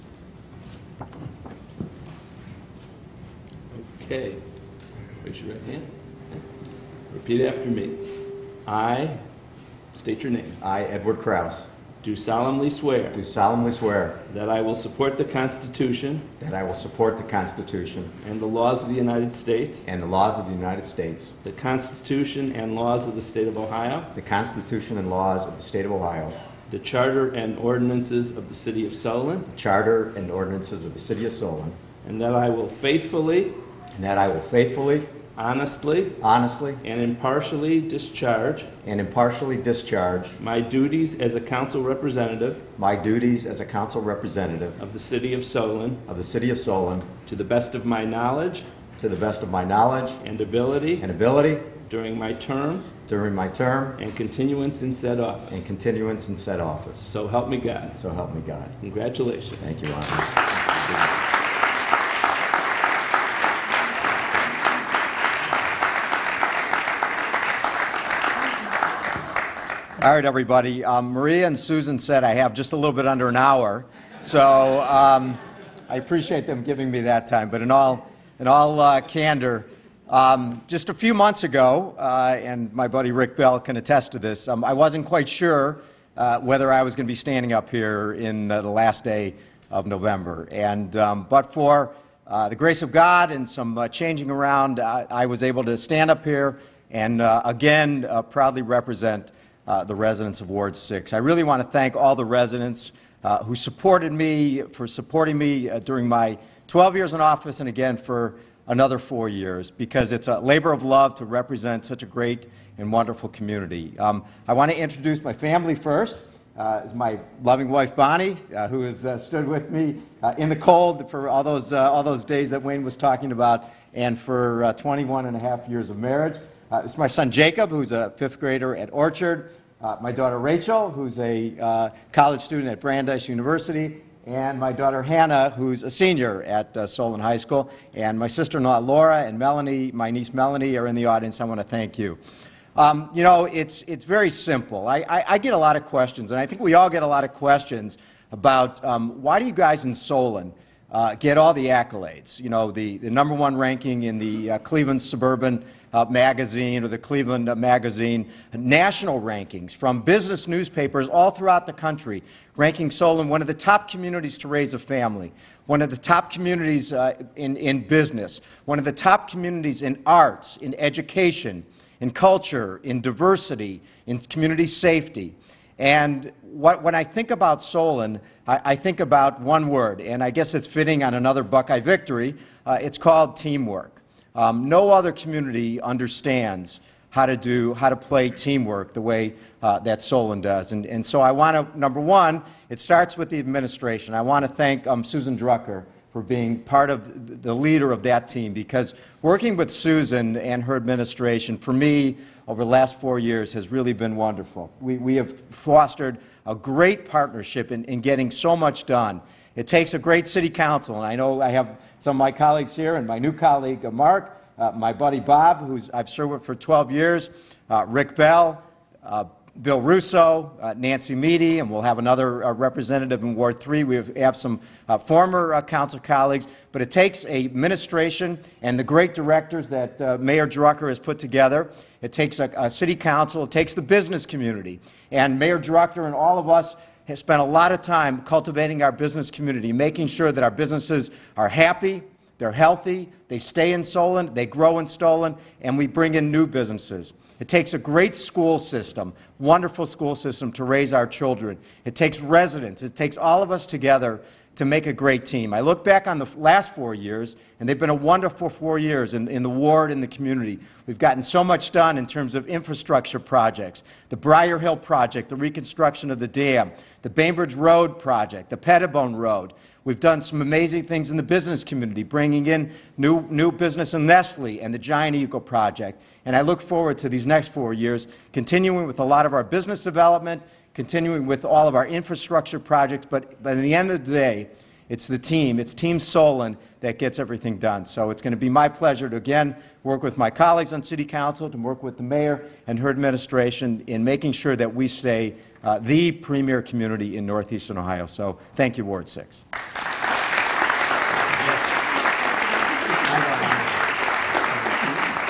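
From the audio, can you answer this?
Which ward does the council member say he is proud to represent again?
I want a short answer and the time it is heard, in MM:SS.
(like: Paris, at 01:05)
Ward 6, at 01:40.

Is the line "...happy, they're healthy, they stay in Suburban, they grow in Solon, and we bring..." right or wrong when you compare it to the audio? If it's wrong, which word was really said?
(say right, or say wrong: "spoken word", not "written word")
wrong: "Solon", not "Suburban".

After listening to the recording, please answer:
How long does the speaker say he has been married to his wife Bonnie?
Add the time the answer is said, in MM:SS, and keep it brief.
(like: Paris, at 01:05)
21 and a half years, at 02:04.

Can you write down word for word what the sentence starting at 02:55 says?
And what, when I think about Solon, I, I, think about one word, and I guess it's fitting on another Buckeye victory.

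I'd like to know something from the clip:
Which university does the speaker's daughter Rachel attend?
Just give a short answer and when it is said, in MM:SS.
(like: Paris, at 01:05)
Brandeis University, at 02:12.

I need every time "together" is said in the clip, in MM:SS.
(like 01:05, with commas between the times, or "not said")
03:51, 04:13.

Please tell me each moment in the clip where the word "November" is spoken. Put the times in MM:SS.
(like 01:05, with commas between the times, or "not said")
01:29.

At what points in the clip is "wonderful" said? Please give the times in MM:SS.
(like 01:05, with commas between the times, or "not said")
01:52, 03:24, 04:09, 04:17.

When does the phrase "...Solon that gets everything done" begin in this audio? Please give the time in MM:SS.
04:45.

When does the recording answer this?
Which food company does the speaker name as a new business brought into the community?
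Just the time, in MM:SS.
04:34.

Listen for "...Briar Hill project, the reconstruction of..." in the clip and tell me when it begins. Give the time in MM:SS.
04:24.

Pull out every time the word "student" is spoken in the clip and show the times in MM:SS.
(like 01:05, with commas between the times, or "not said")
02:12.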